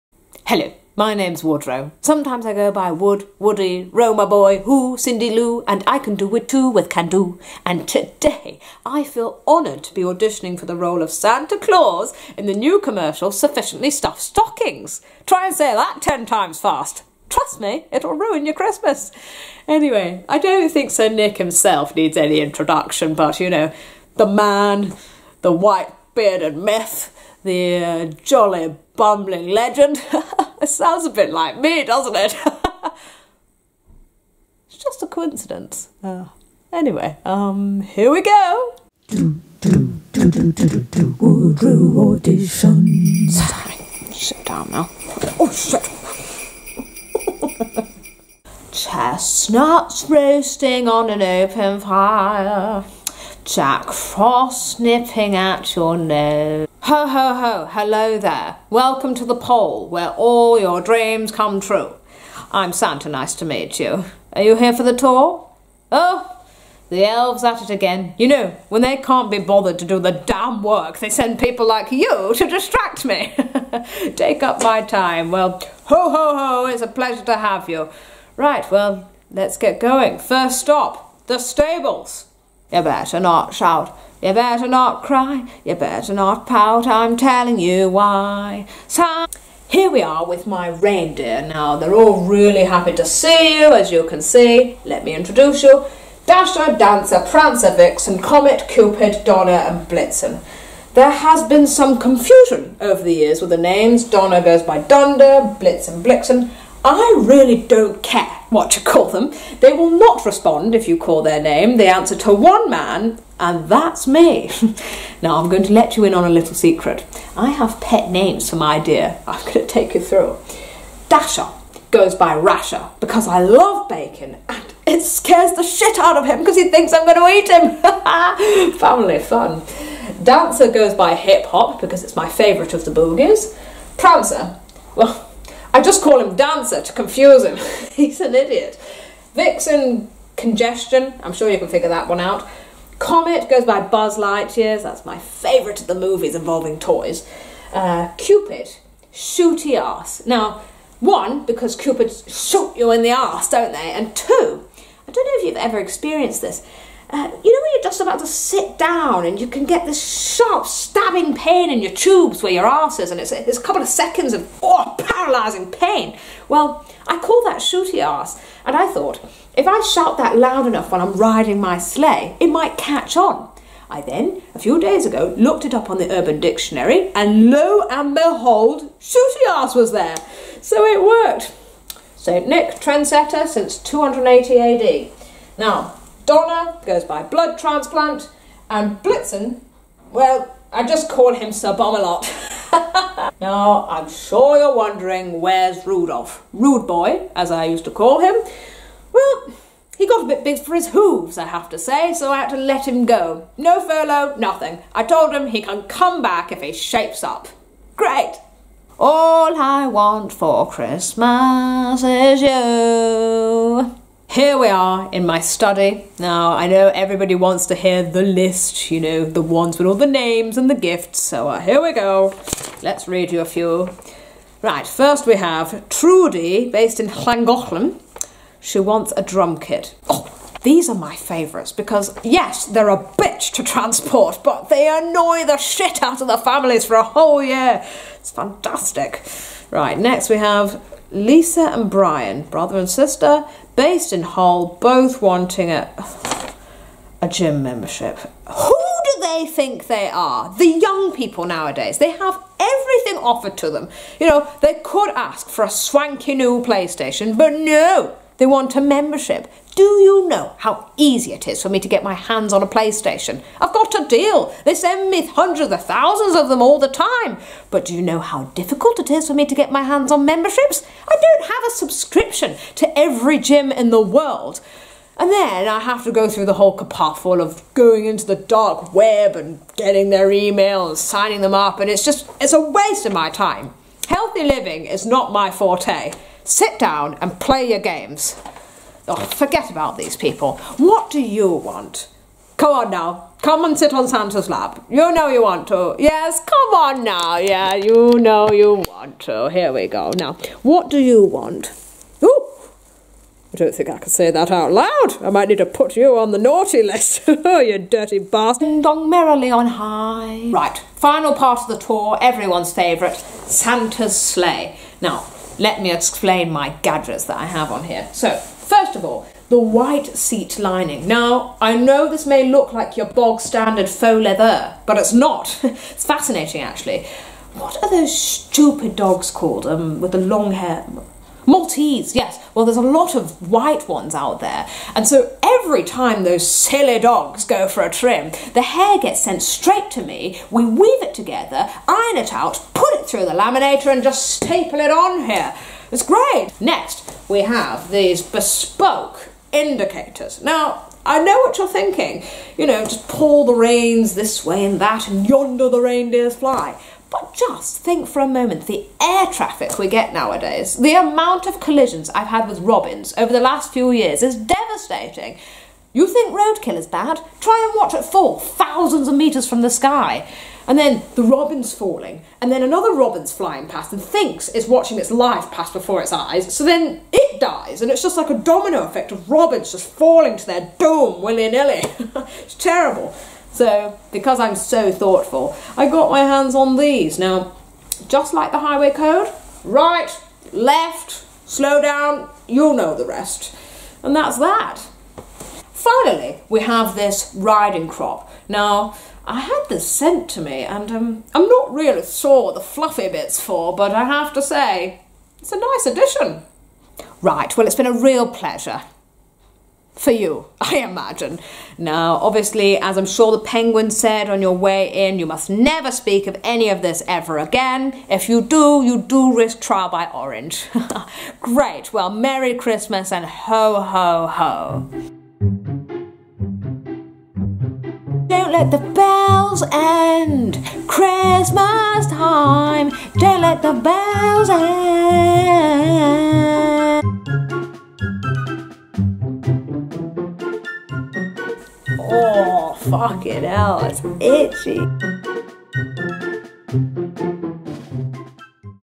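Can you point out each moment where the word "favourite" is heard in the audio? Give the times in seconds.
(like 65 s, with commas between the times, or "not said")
132 s, 145 s, 231 s, 312 s.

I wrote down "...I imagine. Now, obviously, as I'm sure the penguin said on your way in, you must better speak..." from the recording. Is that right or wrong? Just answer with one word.
wrong.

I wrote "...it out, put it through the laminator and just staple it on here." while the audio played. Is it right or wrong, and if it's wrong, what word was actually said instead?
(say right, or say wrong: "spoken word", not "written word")
right.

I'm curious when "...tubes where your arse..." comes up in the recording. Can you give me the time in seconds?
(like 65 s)
161 s.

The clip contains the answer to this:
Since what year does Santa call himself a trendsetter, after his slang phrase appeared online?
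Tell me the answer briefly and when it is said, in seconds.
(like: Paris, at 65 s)
280 AD, at 183 s.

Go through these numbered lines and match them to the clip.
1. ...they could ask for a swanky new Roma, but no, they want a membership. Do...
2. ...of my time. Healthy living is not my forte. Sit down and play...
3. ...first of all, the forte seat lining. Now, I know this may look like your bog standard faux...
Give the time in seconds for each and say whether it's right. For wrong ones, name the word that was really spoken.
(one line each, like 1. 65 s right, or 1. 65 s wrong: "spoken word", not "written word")
1. 254 s wrong: "PlayStation", not "Roma"
2. 283 s right
3. 318 s wrong: "white", not "forte".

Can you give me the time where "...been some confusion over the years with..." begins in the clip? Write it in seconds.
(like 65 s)
101 s.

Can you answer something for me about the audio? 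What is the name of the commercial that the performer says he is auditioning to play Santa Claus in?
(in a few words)
Sufficiently Stuffed Stockings.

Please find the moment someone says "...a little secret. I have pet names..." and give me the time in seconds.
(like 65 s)
116 s.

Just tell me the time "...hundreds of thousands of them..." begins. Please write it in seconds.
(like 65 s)
265 s.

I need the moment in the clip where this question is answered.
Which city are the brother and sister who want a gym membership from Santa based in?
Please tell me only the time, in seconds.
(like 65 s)
244 s.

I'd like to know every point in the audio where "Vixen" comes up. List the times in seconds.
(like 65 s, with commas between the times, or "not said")
97 s, 139 s.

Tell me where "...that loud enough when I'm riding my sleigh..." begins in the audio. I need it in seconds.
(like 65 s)
170 s.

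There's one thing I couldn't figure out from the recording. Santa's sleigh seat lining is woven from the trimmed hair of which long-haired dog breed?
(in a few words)
Maltese.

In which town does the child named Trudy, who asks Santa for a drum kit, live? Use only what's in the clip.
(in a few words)
Llangollen.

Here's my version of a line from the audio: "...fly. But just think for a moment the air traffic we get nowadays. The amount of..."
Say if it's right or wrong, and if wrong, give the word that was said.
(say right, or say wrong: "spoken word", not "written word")
right.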